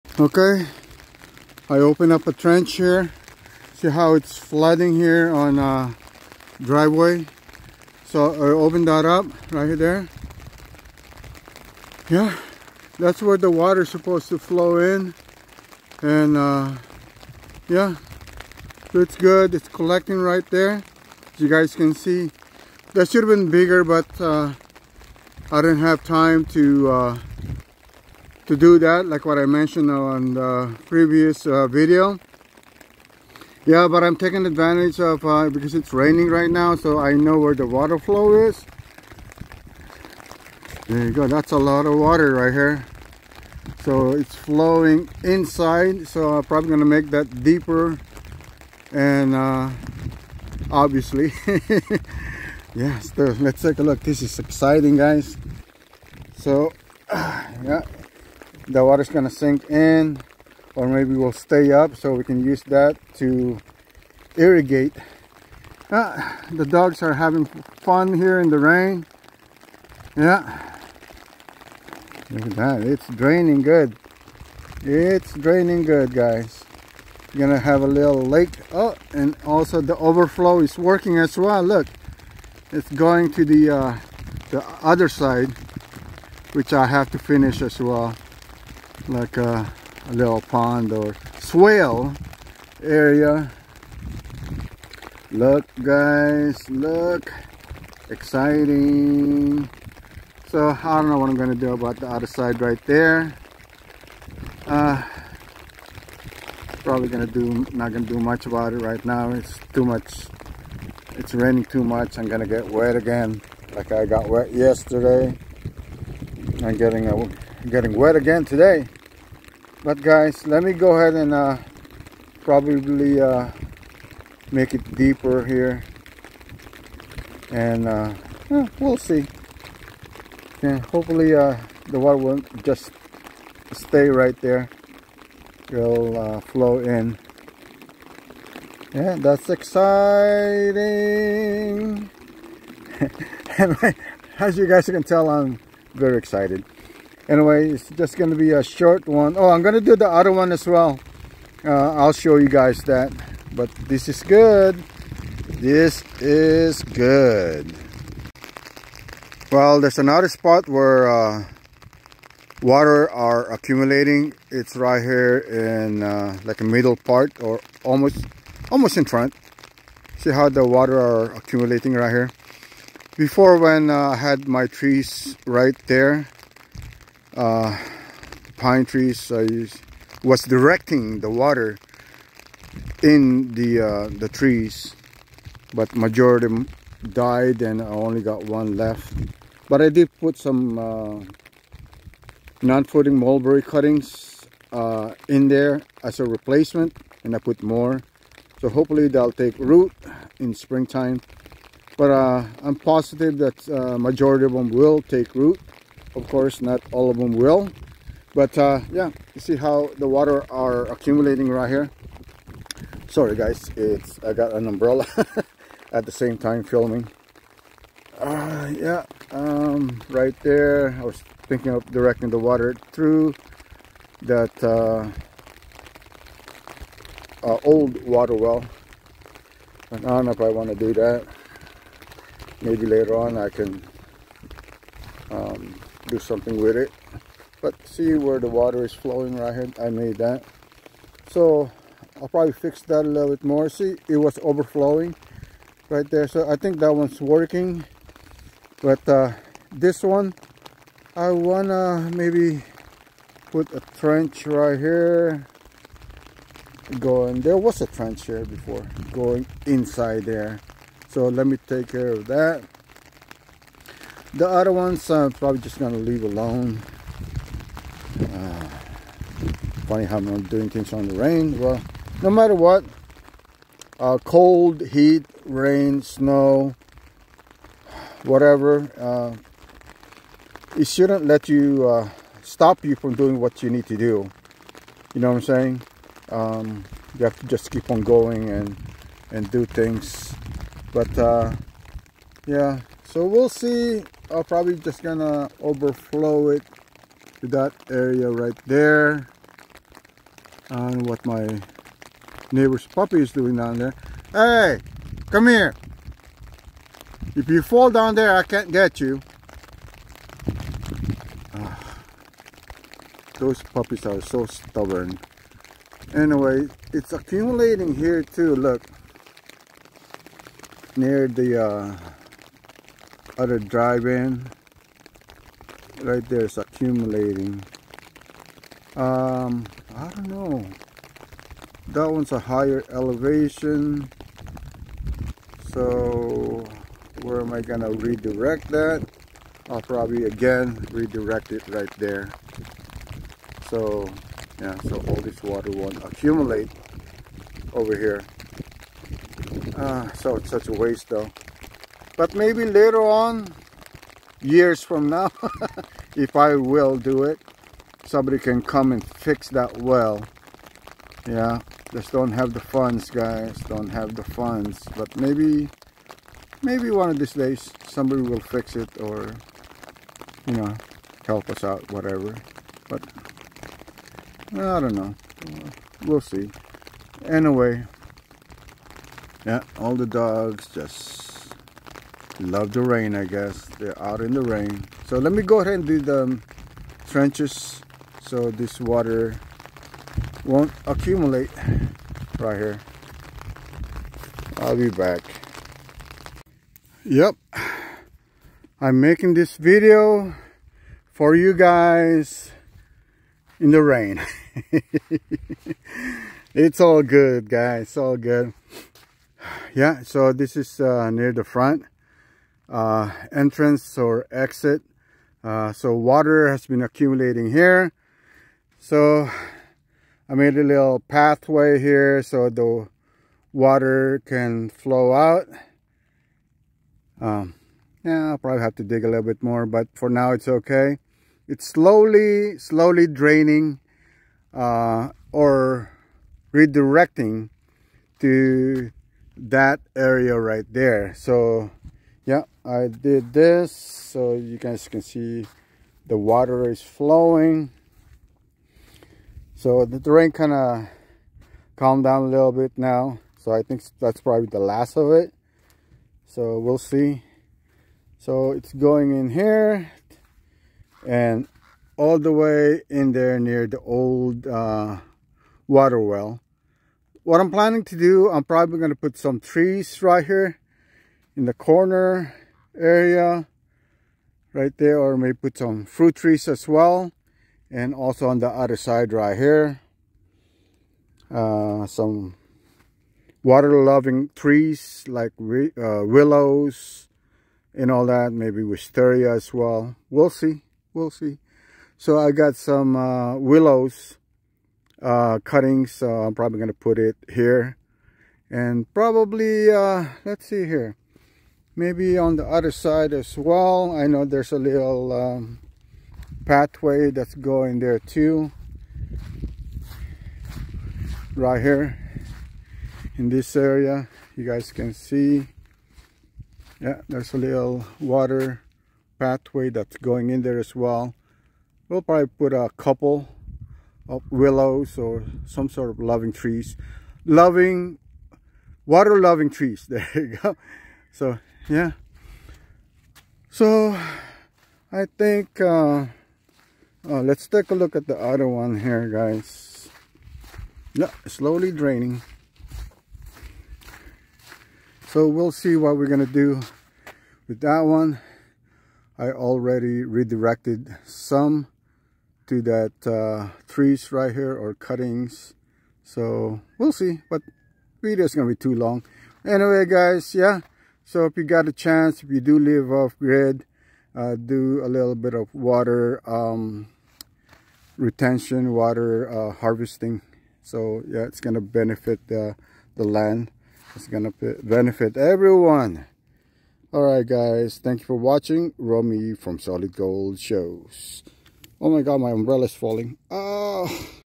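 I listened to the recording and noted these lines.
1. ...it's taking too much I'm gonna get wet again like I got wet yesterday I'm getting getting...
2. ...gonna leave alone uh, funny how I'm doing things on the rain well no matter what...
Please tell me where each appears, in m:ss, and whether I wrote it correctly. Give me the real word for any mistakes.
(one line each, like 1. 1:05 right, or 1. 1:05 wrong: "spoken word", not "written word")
1. 1:51 wrong: "raining", not "taking"
2. 4:25 right.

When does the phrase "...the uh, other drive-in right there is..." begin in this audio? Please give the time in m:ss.
5:21.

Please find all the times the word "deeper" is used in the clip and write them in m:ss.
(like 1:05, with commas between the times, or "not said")
0:47, 2:04.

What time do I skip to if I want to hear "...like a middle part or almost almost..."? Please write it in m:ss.
2:46.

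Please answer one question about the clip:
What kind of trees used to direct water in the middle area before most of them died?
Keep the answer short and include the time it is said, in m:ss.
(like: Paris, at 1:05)
Pine trees, at 2:58.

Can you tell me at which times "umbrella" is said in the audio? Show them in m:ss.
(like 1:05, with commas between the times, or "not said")
3:34, 9:42.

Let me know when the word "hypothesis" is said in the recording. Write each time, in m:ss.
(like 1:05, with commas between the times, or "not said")
not said.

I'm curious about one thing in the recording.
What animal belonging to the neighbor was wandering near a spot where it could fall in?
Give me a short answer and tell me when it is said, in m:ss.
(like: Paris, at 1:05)
Puppy, at 5:02.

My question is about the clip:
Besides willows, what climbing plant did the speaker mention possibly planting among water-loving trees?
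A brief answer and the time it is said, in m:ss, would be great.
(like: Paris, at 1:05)
Wisteria, at 8:08.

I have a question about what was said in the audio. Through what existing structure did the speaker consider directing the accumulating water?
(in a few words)
Old water well.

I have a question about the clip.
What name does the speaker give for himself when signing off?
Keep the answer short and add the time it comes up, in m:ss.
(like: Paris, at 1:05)
Romy, at 9:38.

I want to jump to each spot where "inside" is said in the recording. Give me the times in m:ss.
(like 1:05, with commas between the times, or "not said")
0:45, 4:19.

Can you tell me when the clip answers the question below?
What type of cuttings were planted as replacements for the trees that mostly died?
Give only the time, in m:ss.
3:12.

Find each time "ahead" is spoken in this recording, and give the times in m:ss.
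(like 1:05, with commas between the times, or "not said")
2:00, 6:25.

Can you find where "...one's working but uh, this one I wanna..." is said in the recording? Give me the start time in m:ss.
4:06.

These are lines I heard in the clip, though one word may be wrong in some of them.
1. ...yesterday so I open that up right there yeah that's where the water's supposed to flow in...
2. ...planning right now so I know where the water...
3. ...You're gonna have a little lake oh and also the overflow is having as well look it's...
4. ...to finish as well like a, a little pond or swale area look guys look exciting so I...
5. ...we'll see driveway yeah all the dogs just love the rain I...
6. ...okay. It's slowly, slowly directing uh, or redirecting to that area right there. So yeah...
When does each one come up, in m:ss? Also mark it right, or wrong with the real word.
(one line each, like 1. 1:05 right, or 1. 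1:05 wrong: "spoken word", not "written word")
1. 0:06 wrong: "driveway", not "yesterday"
2. 0:35 wrong: "raining", not "planning"
3. 1:17 wrong: "working", not "having"
4. 1:27 right
5. 6:16 wrong: "anyway", not "driveway"
6. 7:10 wrong: "draining", not "directing".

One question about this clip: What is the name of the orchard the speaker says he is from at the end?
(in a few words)
Dalisay Orchard.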